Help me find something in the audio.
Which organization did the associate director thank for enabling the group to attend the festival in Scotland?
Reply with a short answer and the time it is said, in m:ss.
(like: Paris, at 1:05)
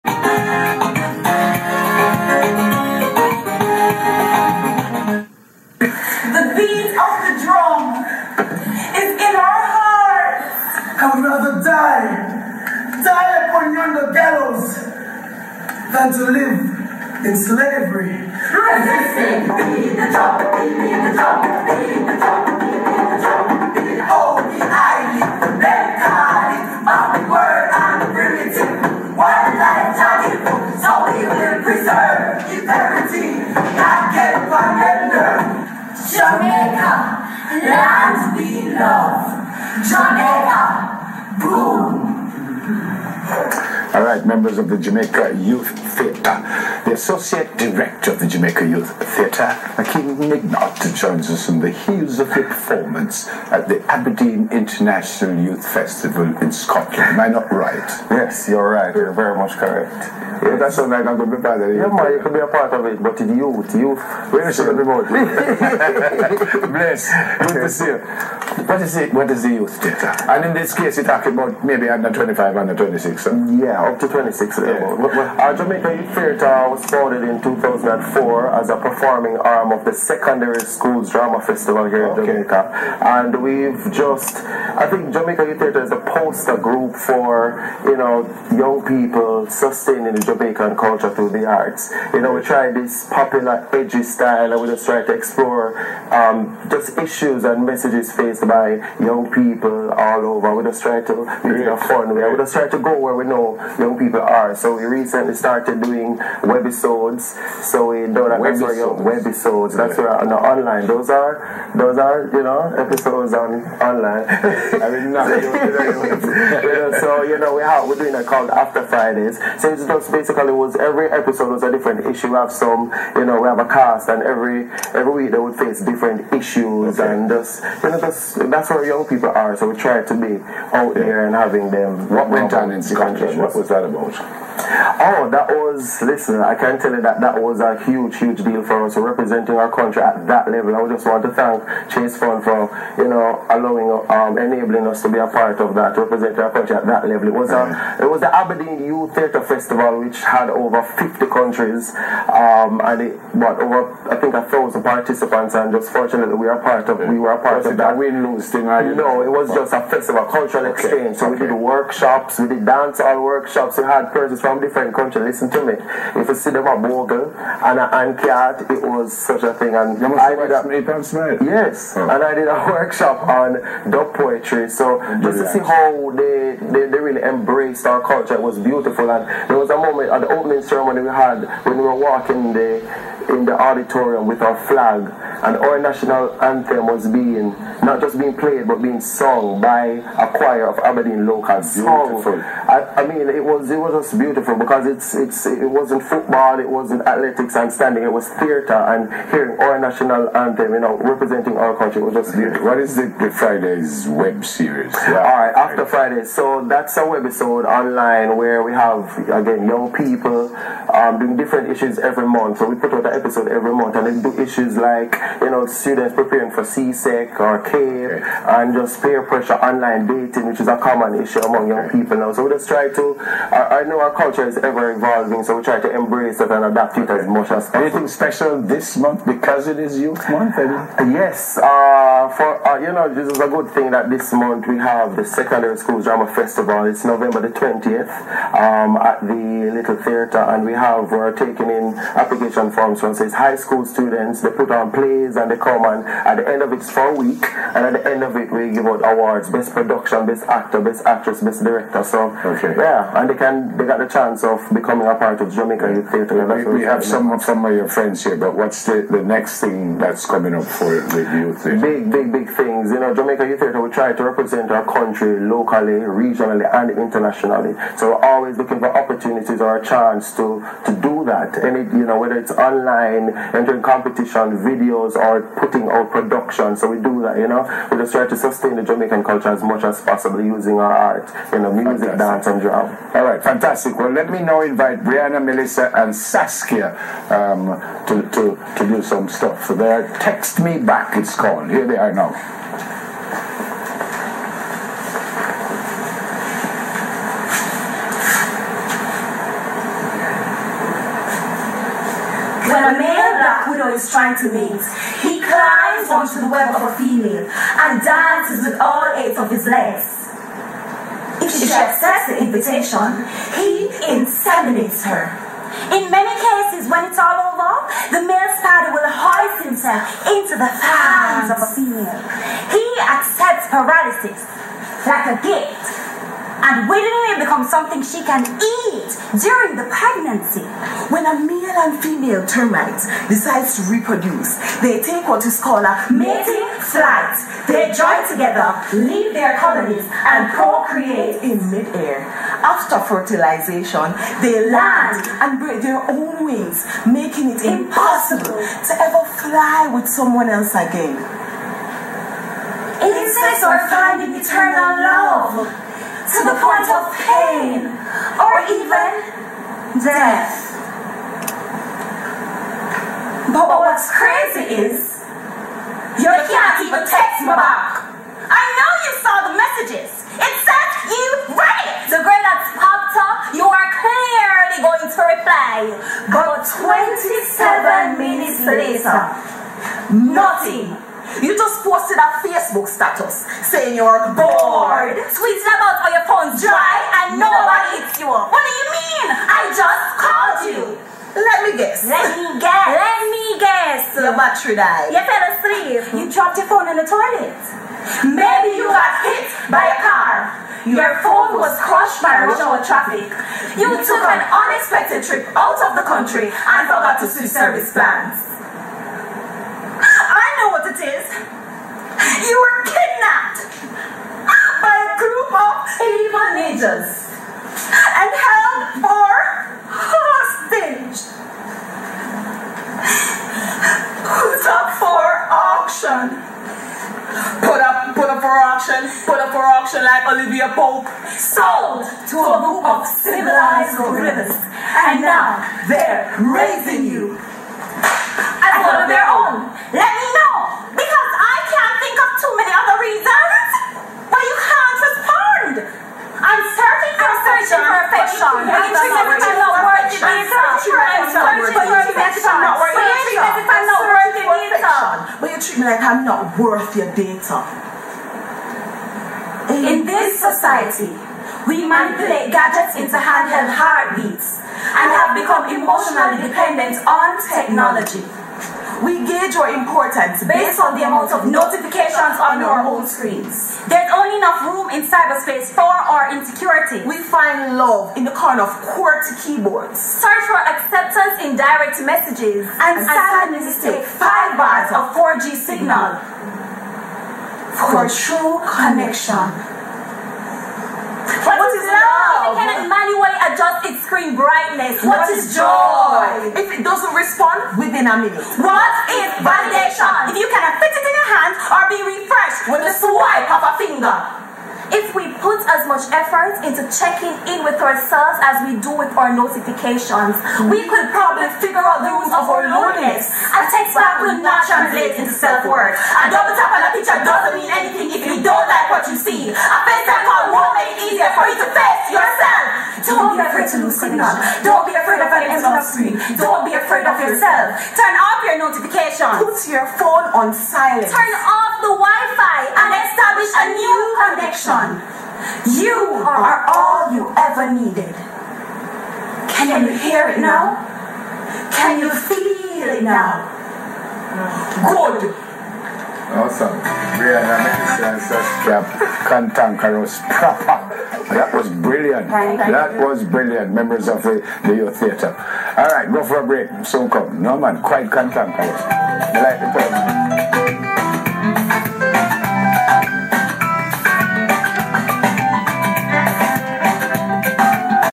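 Chase Fund, at 2:21.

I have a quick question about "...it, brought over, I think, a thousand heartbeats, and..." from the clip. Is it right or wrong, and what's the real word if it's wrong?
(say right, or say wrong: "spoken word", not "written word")
wrong: "participants", not "heartbeats".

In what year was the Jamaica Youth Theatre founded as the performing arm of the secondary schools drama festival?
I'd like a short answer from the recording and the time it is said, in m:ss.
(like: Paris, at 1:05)
2004, at 1:17.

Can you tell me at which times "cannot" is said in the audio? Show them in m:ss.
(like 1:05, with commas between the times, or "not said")
8:12, 8:20.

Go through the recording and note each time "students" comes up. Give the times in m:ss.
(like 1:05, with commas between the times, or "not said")
3:35, 4:03.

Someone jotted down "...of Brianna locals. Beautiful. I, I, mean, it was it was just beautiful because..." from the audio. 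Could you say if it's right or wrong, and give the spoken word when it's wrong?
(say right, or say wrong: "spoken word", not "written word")
wrong: "Aberdeen", not "Brianna".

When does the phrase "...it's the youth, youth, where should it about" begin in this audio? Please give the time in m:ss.
1:03.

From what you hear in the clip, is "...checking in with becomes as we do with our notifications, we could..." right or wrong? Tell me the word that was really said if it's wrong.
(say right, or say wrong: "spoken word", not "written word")
wrong: "ourselves", not "becomes".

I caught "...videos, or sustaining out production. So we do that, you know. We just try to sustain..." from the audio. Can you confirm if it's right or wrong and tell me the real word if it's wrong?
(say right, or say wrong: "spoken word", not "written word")
wrong: "putting", not "sustaining".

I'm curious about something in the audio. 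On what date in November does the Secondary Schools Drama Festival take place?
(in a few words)
November 20.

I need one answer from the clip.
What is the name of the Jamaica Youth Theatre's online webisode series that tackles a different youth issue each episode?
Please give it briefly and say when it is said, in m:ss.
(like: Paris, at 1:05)
After Fridays, at 1:58.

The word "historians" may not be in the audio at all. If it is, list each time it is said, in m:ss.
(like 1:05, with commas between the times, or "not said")
not said.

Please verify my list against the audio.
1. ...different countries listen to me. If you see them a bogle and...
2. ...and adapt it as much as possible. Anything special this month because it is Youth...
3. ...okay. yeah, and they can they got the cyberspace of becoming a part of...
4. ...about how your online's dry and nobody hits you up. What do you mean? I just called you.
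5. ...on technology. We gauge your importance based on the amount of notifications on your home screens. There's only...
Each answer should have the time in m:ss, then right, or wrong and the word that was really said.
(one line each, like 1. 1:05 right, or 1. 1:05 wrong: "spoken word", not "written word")
1. 2:44 right
2. 3:46 right
3. 4:12 wrong: "chance", not "cyberspace"
4. 6:25 wrong: "phone", not "online"
5. 7:47 right.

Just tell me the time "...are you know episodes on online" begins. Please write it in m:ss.
1:51.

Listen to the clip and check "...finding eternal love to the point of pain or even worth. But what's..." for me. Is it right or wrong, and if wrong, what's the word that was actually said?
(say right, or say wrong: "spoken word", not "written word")
wrong: "death", not "worth".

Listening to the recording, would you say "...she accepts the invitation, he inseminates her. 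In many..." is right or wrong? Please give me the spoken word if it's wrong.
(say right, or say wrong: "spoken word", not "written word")
right.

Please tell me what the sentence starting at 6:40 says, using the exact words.
Your phone was crushed by rush hour traffic.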